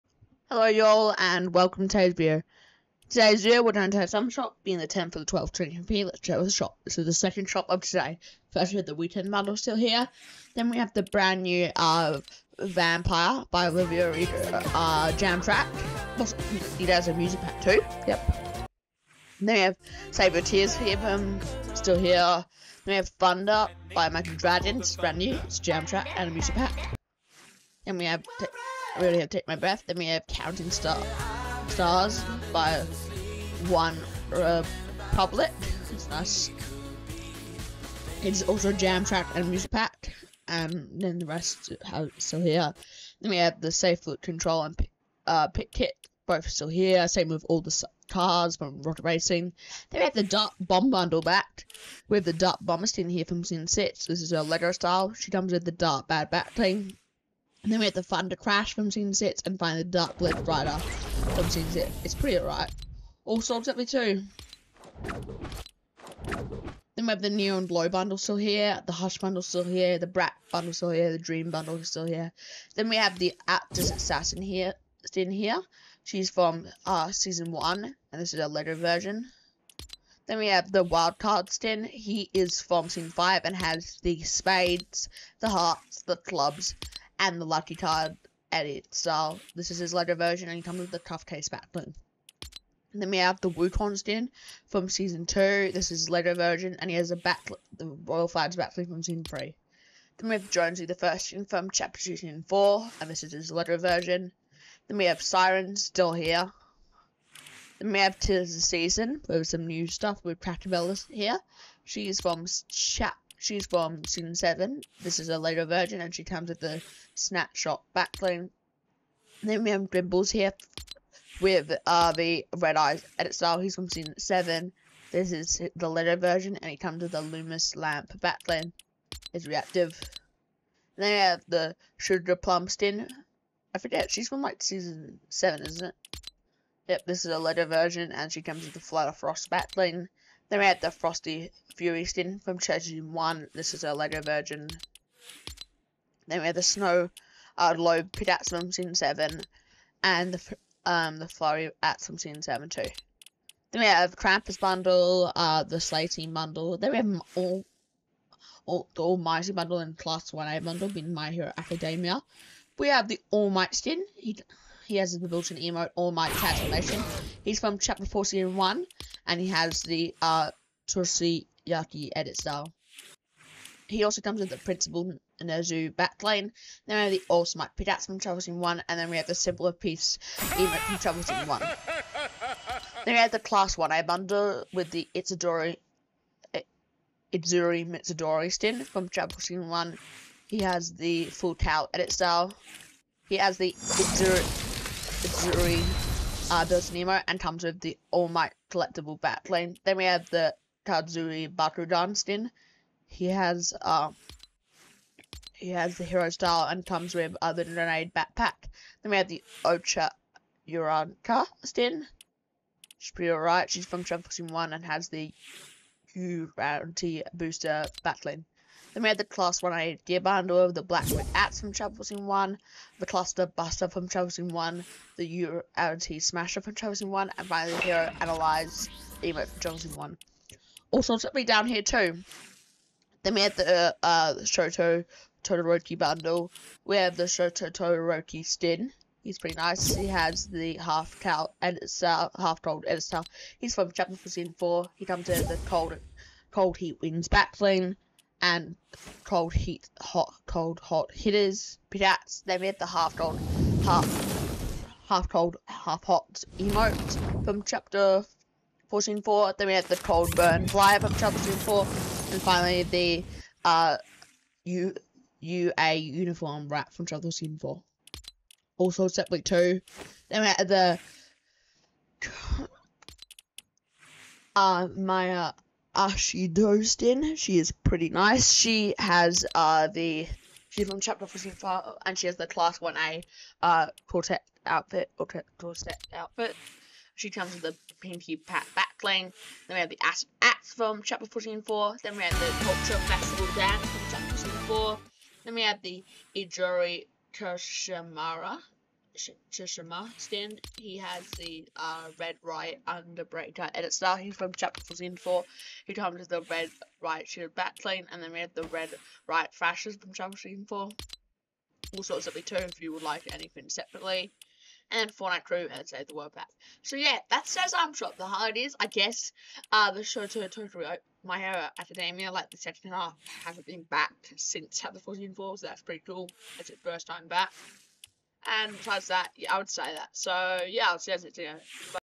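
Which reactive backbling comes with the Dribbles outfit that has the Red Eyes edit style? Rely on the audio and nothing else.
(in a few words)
Loomis Lamp.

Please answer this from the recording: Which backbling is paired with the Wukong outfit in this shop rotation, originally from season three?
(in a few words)
Royal Flags.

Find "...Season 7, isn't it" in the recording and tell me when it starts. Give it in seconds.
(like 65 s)
134 s.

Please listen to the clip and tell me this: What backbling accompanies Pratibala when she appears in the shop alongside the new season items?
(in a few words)
Snapshot.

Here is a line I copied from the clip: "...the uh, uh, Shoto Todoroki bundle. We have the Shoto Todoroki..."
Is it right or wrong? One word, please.
right.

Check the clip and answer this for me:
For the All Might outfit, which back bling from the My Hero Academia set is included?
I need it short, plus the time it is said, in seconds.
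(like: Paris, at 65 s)
Principal Nezu, at 174 s.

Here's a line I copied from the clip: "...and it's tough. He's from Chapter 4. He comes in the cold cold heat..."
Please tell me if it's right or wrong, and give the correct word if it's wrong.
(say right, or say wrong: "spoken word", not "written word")
right.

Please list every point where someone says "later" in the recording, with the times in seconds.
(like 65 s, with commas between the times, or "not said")
78 s, 89 s, 96 s, 103 s, 115 s, 125 s, 137 s, 331 s.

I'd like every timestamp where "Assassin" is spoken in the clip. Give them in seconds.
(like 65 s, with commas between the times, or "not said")
73 s.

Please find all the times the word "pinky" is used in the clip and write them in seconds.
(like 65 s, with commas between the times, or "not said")
287 s.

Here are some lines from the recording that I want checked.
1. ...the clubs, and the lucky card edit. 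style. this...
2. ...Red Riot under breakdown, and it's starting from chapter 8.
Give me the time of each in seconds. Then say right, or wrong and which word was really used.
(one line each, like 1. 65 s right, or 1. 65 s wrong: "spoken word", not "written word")
1. 86 s right
2. 302 s wrong: "4", not "8".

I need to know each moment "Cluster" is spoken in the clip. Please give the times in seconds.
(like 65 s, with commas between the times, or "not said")
223 s.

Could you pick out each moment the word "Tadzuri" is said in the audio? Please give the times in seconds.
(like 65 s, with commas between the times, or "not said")
200 s.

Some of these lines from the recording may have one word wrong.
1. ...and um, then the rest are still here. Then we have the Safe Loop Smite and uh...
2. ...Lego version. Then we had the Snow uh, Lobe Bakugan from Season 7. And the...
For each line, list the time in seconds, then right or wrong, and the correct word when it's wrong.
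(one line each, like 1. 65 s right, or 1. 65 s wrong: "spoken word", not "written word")
1. 40 s wrong: "Control", not "Smite"
2. 143 s wrong: "Pitats", not "Bakugan".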